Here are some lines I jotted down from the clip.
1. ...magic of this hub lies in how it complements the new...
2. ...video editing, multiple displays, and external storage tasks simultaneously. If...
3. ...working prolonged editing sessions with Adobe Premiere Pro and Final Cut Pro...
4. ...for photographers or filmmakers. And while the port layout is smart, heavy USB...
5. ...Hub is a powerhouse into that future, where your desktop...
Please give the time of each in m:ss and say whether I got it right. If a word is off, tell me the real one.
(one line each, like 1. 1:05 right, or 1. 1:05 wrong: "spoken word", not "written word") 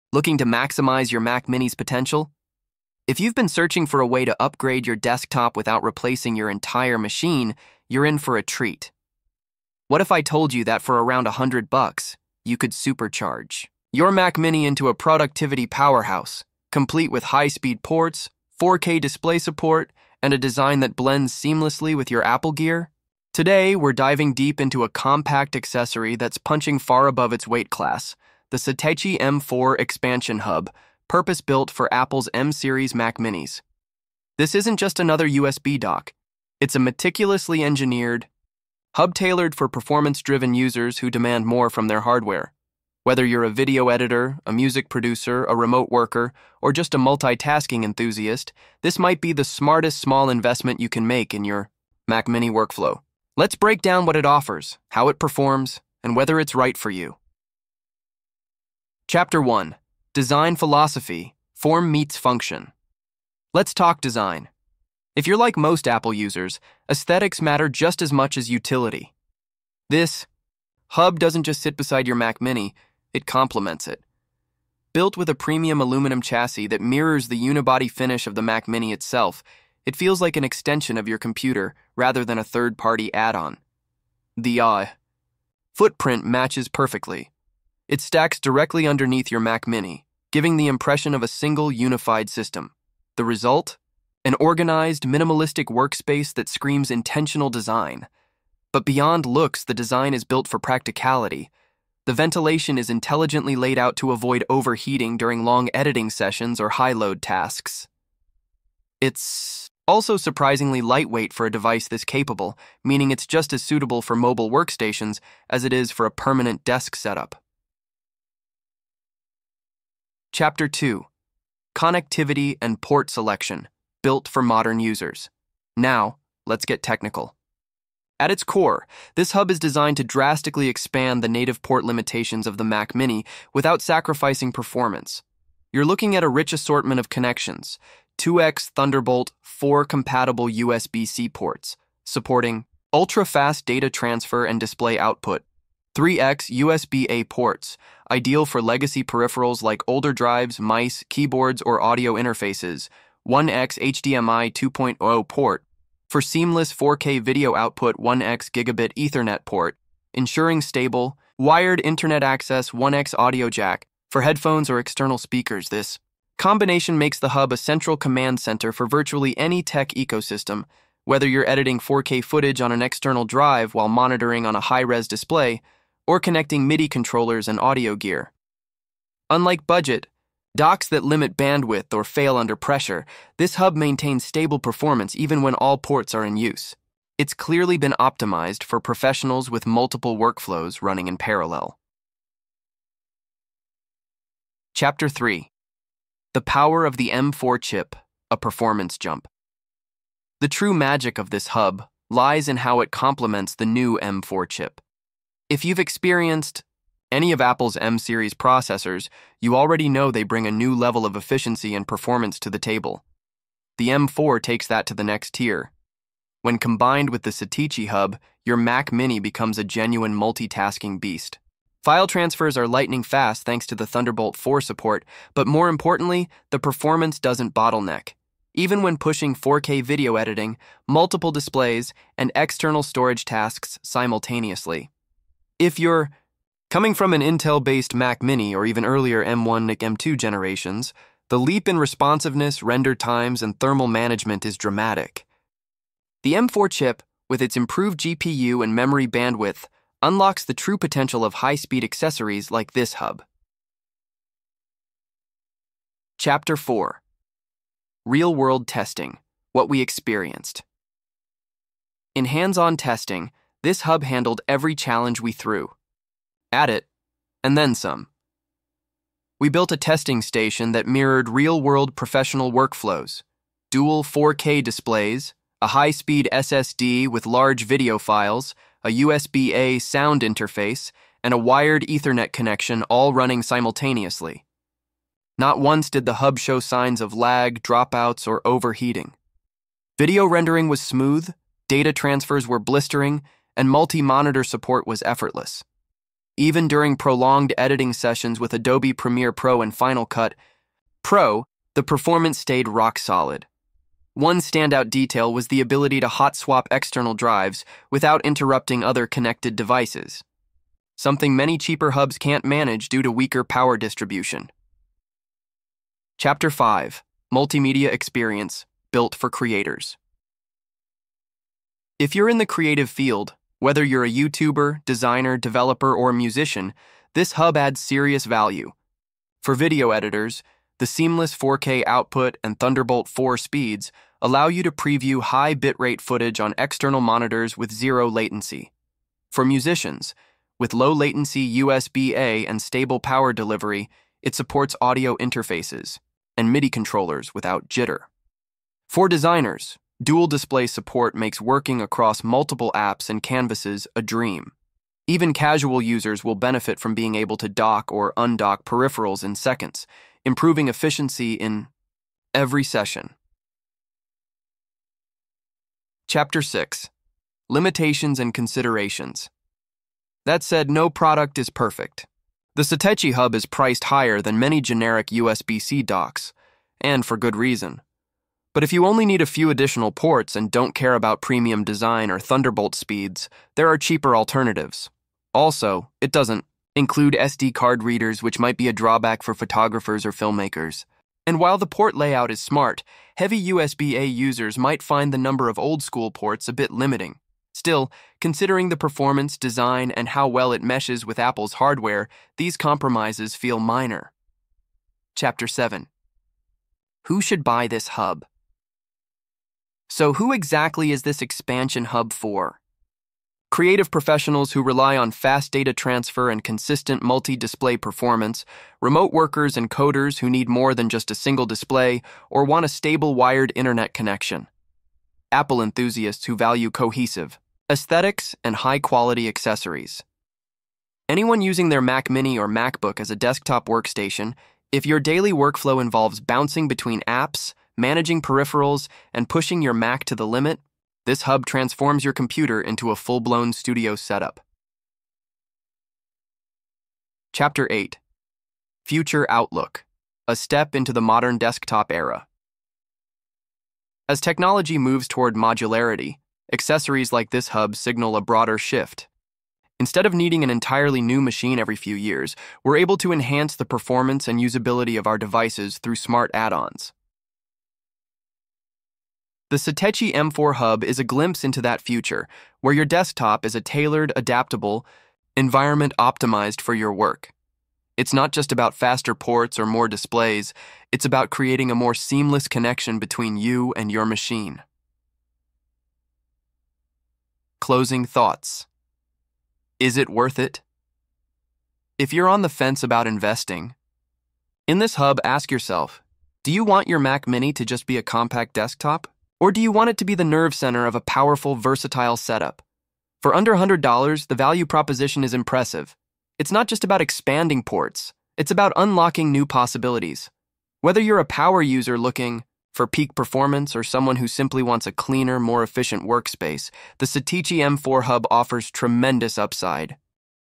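1. 3:20 right
2. 3:49 right
3. 4:56 wrong: "during", not "working"
4. 6:29 right
5. 7:50 wrong: "glimpse", not "powerhouse".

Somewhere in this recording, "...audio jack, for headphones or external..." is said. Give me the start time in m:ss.
2:43.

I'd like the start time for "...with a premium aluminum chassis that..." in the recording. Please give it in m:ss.
1:15.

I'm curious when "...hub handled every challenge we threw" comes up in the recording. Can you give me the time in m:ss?
4:23.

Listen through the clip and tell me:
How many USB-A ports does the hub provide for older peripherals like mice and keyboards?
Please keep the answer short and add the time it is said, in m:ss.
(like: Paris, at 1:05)
3, at 2:25.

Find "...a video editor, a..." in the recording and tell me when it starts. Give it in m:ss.
0:43.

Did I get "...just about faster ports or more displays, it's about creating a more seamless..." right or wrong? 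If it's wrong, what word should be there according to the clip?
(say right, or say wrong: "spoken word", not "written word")
right.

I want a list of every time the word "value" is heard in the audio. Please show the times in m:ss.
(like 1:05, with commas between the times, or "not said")
5:28, 7:06, 8:24.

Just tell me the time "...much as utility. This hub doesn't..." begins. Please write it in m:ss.
1:08.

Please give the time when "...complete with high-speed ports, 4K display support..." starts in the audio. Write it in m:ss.
0:16.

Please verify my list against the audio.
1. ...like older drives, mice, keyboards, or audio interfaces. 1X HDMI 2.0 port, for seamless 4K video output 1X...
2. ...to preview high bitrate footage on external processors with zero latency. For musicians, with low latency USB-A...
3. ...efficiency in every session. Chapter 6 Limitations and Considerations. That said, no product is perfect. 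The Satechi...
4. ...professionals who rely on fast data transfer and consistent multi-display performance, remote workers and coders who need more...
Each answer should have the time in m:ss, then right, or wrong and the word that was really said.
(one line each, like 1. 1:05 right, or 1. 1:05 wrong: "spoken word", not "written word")
1. 2:29 right
2. 5:34 wrong: "monitors", not "processors"
3. 6:00 right
4. 6:53 right.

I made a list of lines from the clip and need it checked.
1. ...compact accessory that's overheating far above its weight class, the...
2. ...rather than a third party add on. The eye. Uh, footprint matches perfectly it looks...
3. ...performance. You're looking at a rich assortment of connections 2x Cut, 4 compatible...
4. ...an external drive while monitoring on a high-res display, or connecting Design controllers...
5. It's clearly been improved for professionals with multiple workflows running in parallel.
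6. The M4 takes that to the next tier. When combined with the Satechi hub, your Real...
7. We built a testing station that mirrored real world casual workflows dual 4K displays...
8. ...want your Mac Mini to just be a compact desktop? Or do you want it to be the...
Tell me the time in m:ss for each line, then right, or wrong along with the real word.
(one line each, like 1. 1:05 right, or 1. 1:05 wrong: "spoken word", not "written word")
1. 0:24 wrong: "punching", not "overheating"
2. 1:21 wrong: "stacks", not "looks"
3. 2:14 wrong: "Thunderbolt", not "Cut"
4. 2:52 wrong: "MIDI", not "Design"
5. 3:07 wrong: "optimized", not "improved"
6. 3:33 wrong: "Mac", not "Real"
7. 4:29 wrong: "professional", not "casual"
8. 8:16 right.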